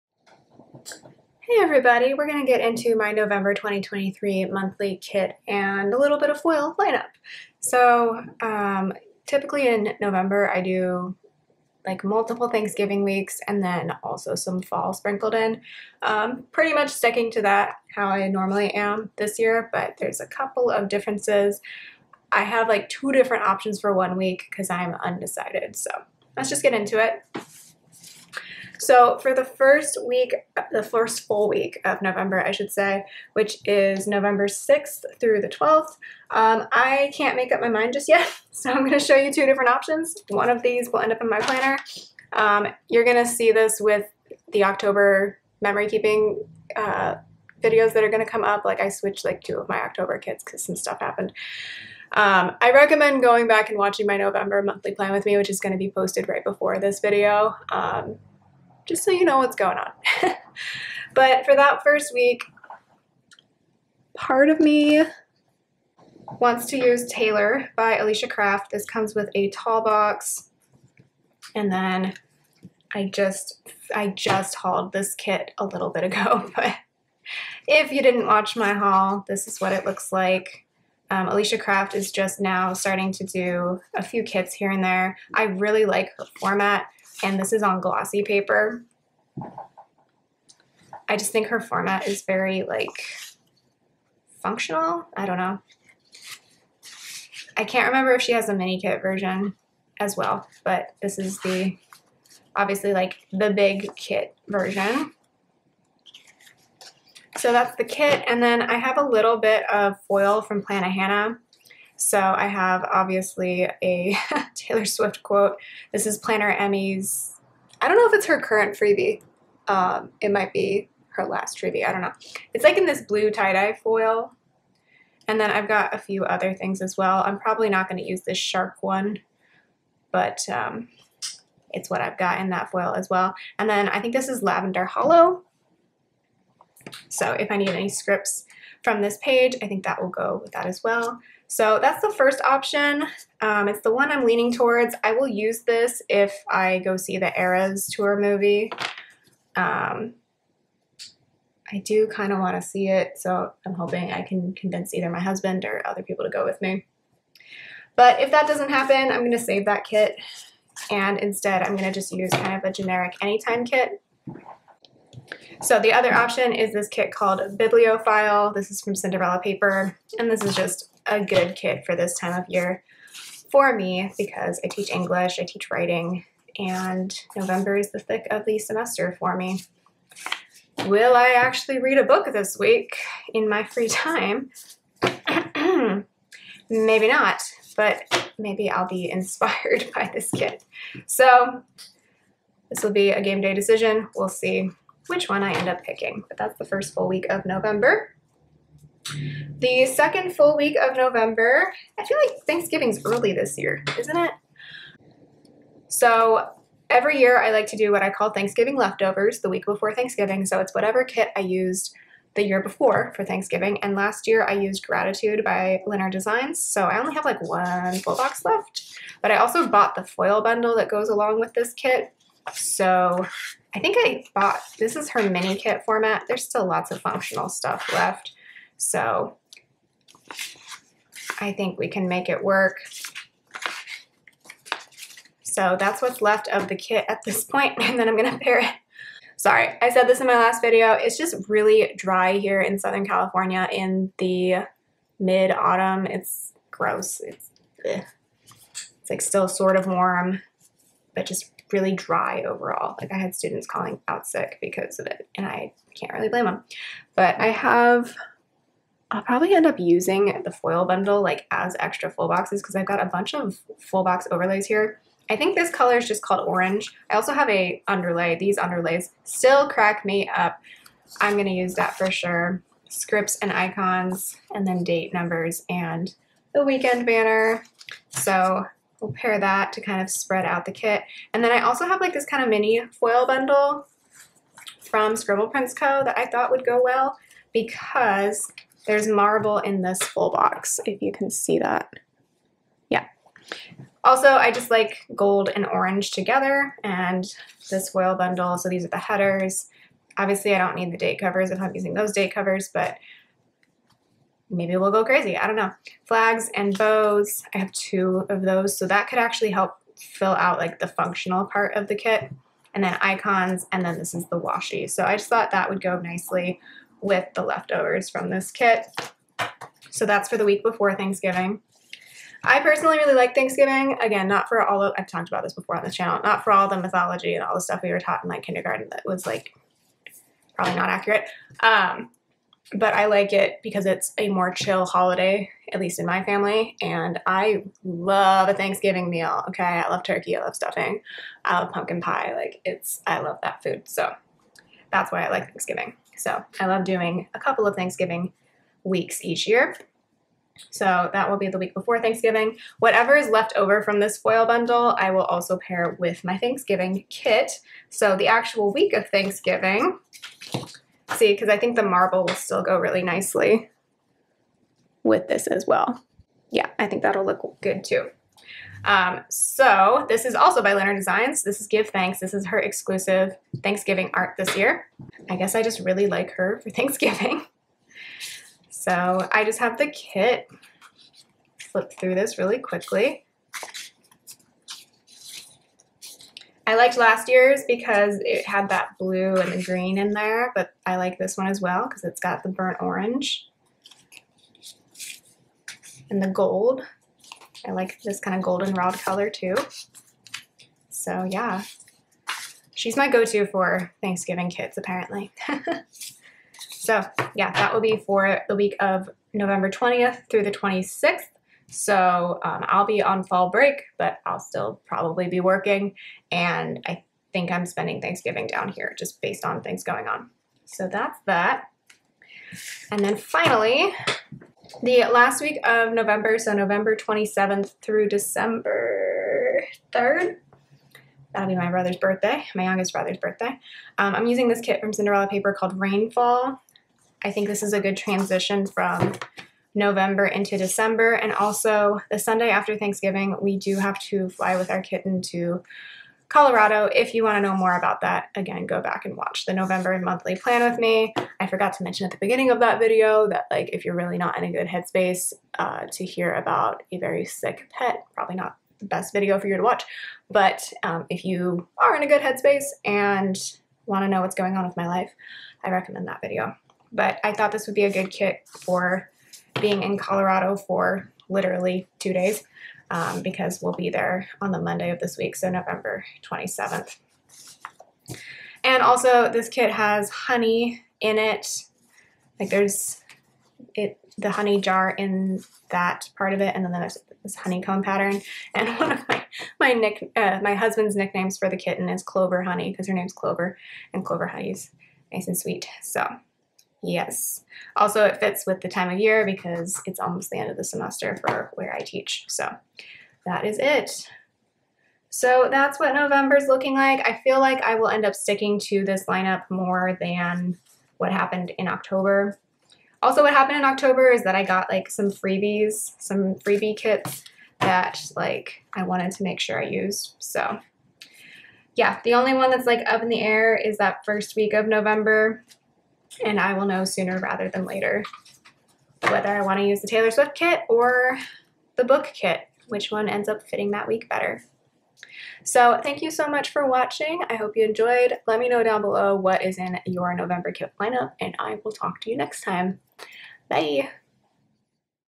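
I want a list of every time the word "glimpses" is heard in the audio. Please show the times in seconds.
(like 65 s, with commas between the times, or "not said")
not said.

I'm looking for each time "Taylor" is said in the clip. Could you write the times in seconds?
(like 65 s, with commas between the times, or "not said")
67 s, 114 s, 529 s.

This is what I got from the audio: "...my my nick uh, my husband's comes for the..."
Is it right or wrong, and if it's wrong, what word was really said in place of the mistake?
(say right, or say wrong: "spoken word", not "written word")
wrong: "nicknames", not "comes".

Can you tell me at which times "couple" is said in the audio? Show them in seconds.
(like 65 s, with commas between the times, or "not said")
20 s, 347 s.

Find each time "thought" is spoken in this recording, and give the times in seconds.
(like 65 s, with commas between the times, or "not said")
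286 s, 315 s, 467 s.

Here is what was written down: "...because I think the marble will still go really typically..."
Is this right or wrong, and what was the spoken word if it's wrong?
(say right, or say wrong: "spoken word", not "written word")
wrong: "nicely", not "typically".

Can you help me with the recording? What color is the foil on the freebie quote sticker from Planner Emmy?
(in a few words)
blue tie-dye.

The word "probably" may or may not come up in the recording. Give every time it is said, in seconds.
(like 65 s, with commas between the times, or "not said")
127 s, 259 s, 330 s, 414 s, 458 s.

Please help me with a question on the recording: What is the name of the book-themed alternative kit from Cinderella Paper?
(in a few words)
Bibliophile.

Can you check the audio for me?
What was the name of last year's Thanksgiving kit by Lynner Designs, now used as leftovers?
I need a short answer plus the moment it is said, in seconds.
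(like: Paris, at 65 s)
Gratitude, at 214 s.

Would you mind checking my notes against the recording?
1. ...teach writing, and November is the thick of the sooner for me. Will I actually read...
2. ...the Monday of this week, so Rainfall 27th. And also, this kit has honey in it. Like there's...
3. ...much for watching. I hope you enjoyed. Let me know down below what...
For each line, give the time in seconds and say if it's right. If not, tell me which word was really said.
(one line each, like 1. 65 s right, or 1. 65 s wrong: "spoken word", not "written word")
1. 175 s wrong: "semester", not "sooner"
2. 474 s wrong: "November", not "Rainfall"
3. 536 s right.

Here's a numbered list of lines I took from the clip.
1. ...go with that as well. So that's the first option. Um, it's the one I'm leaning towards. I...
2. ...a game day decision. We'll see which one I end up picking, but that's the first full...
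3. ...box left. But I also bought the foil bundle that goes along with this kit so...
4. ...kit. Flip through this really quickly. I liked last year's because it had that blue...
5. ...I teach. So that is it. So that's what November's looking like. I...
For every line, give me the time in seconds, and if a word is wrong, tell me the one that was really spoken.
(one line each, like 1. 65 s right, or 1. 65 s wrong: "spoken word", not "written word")
1. 140 s right
2. 193 s right
3. 218 s right
4. 379 s right
5. 501 s right.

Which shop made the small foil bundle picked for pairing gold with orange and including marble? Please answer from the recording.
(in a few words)
Scribble Prints Co.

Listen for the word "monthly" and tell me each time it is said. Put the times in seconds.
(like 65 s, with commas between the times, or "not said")
4 s, 54 s, 449 s.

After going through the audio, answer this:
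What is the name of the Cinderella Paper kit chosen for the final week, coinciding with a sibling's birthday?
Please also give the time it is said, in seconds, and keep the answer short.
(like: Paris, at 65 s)
Rainfall, at 435 s.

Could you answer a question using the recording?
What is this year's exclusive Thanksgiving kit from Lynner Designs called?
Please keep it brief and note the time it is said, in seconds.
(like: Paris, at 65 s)
Give Thanks, at 371 s.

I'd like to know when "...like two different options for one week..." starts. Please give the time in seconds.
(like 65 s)
22 s.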